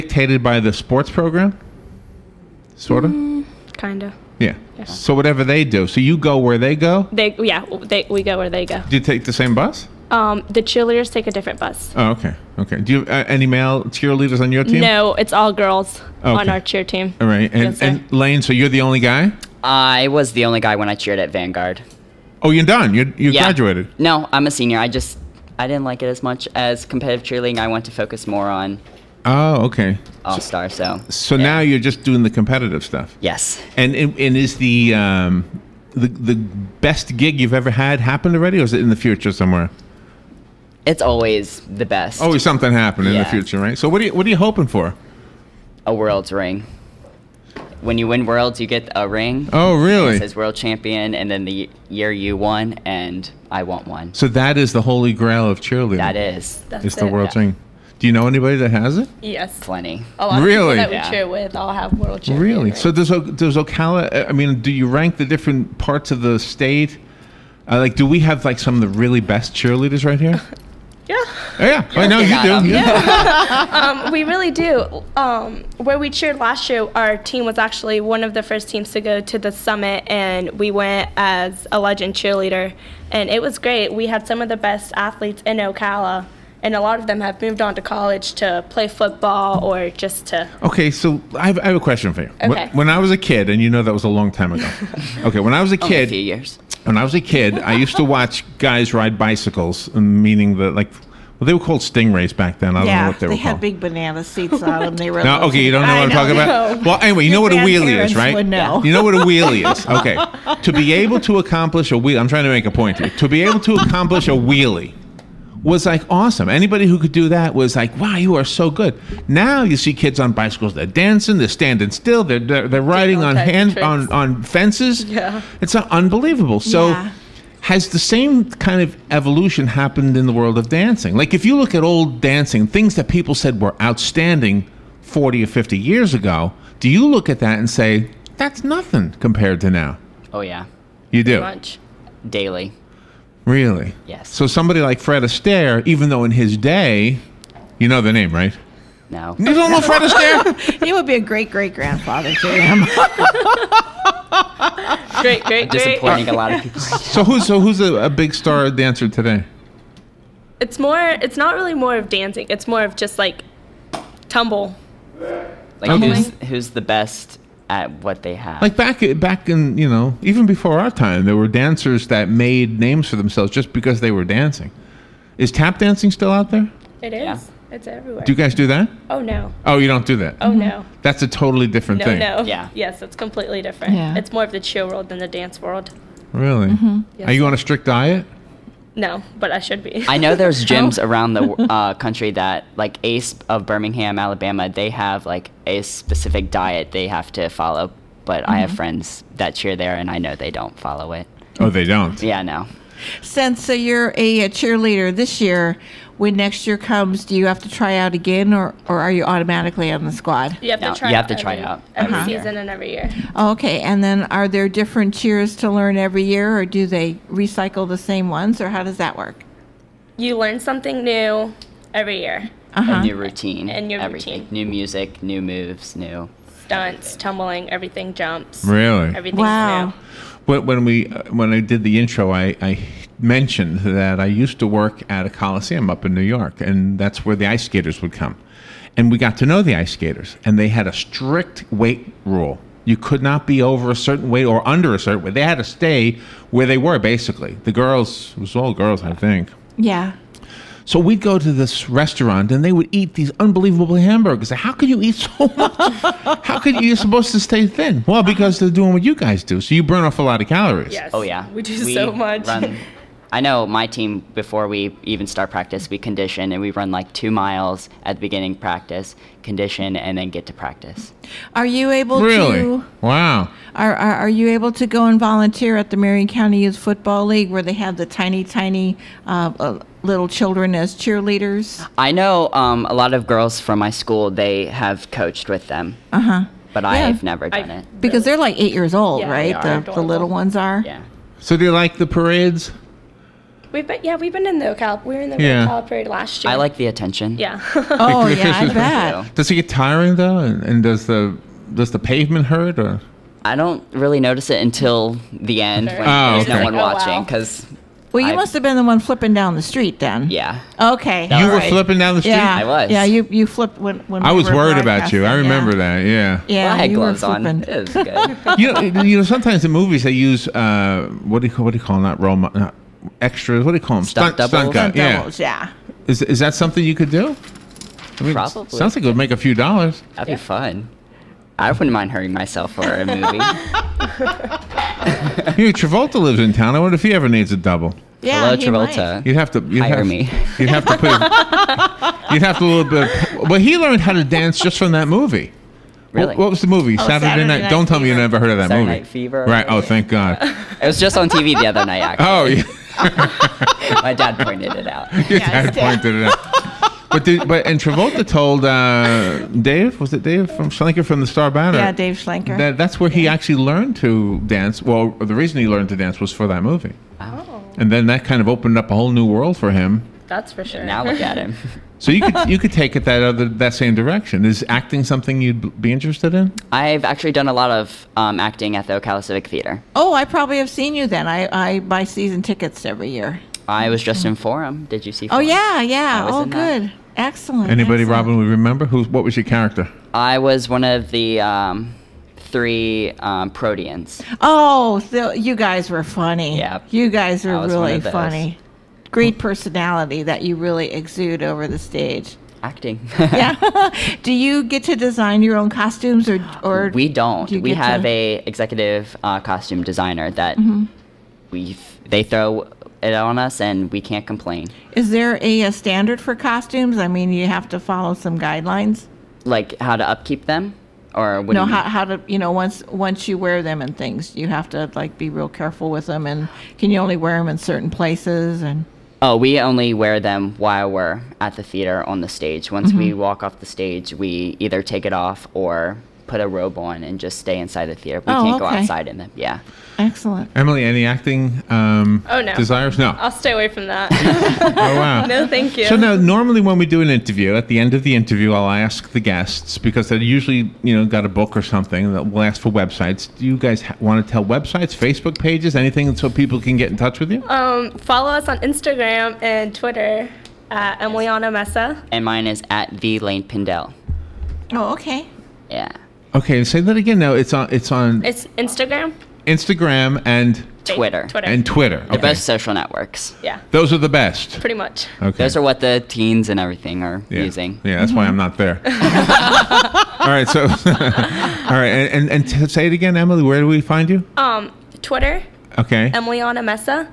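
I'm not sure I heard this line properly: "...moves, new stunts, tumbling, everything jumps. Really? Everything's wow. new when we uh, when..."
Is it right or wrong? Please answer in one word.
right.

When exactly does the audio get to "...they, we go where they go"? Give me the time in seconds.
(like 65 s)
7 s.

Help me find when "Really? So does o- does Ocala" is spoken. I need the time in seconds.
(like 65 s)
62 s.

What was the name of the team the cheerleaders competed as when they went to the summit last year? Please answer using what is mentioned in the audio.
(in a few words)
Legend.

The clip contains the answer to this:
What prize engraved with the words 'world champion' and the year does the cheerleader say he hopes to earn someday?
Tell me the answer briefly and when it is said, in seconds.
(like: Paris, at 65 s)
A world's ring, at 45 s.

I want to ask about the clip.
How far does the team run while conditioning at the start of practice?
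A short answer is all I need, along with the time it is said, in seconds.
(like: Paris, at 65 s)
2 miles, at 267 s.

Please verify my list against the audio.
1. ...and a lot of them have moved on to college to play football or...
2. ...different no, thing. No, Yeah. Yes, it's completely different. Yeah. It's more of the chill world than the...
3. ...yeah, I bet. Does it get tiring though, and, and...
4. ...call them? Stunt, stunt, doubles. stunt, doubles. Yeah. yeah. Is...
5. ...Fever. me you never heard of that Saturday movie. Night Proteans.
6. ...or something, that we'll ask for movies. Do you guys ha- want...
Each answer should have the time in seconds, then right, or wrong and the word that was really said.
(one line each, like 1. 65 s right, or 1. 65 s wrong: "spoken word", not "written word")
1. 86 s right
2. 181 s right
3. 298 s right
4. 323 s right
5. 347 s wrong: "Fever", not "Proteans"
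6. 451 s wrong: "websites", not "movies".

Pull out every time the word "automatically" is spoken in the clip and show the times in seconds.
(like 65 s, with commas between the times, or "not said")
209 s.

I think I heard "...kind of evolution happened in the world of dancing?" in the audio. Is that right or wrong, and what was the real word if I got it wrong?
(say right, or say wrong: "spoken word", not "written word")
right.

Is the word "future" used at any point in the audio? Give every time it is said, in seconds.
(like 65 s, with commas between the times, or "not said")
38 s, 43 s.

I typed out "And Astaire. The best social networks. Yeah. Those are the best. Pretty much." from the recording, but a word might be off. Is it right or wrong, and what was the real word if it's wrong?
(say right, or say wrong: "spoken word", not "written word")
wrong: "Twitter", not "Astaire".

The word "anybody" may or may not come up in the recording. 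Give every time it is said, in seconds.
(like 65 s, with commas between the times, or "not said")
58 s, 116 s, 387 s.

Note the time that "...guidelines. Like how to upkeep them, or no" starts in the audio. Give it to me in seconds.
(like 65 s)
418 s.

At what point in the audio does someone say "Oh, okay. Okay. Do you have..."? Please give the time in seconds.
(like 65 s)
11 s.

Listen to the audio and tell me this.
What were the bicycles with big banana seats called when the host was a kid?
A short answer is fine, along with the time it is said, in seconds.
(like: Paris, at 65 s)
Stingrays, at 101 s.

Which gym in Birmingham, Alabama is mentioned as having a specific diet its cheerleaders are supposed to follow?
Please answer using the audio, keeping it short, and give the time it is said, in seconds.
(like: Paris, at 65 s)
Ace, at 193 s.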